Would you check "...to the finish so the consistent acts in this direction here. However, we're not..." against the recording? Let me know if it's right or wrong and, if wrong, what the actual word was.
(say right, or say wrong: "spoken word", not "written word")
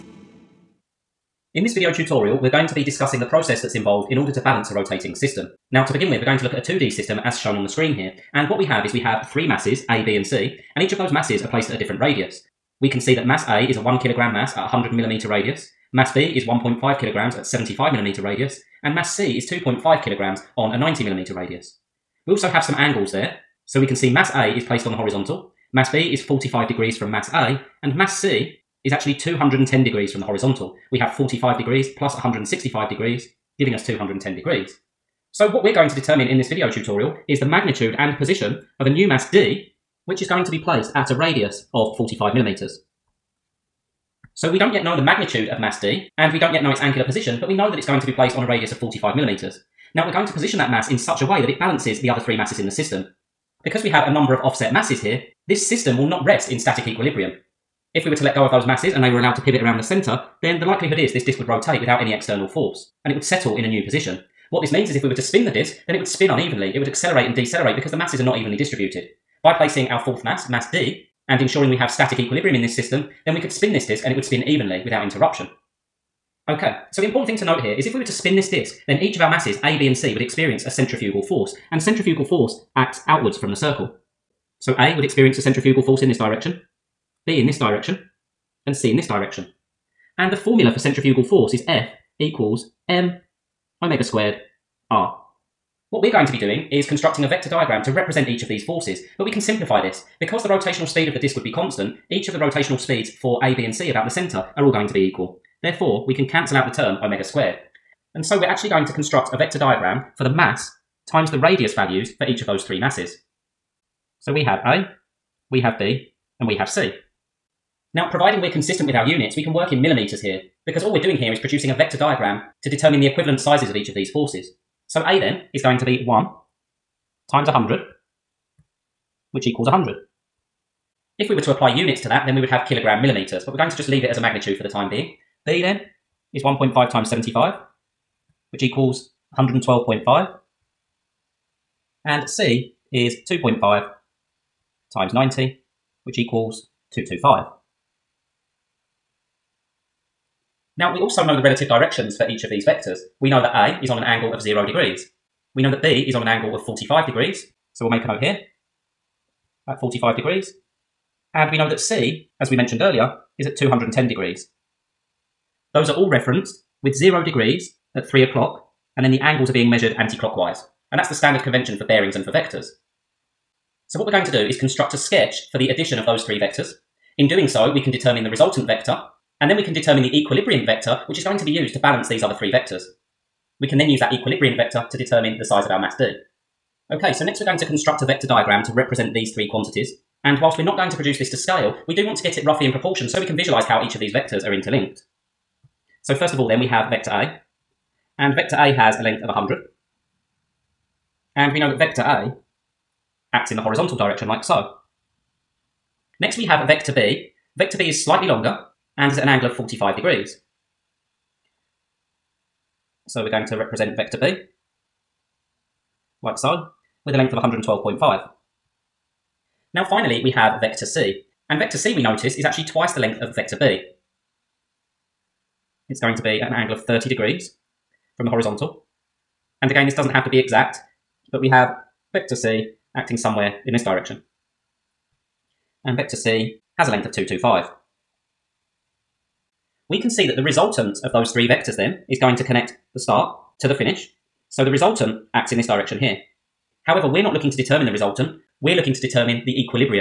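wrong: "resultant", not "consistent".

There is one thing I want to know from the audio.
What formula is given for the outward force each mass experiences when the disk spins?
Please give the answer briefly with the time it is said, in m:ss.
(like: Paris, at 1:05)
F equals m omega squared r, at 1:32.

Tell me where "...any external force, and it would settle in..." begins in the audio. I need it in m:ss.
1:02.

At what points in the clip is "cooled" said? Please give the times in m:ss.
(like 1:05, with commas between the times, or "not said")
not said.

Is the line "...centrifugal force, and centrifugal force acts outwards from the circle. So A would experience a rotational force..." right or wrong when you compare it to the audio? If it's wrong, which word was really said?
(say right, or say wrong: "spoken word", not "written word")
wrong: "centrifugal", not "rotational".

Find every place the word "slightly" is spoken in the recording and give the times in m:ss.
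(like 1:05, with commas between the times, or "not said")
3:28.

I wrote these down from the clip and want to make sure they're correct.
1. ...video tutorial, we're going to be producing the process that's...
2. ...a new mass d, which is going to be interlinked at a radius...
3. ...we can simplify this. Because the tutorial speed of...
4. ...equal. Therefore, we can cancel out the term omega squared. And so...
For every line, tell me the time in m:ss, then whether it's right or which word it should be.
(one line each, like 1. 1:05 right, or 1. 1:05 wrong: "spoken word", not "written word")
1. 0:01 wrong: "discussing", not "producing"
2. 0:38 wrong: "placed", not "interlinked"
3. 1:39 wrong: "rotational", not "tutorial"
4. 1:44 right.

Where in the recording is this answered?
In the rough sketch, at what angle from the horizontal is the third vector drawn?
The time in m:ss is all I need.
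3:46.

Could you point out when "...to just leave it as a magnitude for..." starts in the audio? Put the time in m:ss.
2:13.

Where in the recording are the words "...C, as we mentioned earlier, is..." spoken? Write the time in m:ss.
2:41.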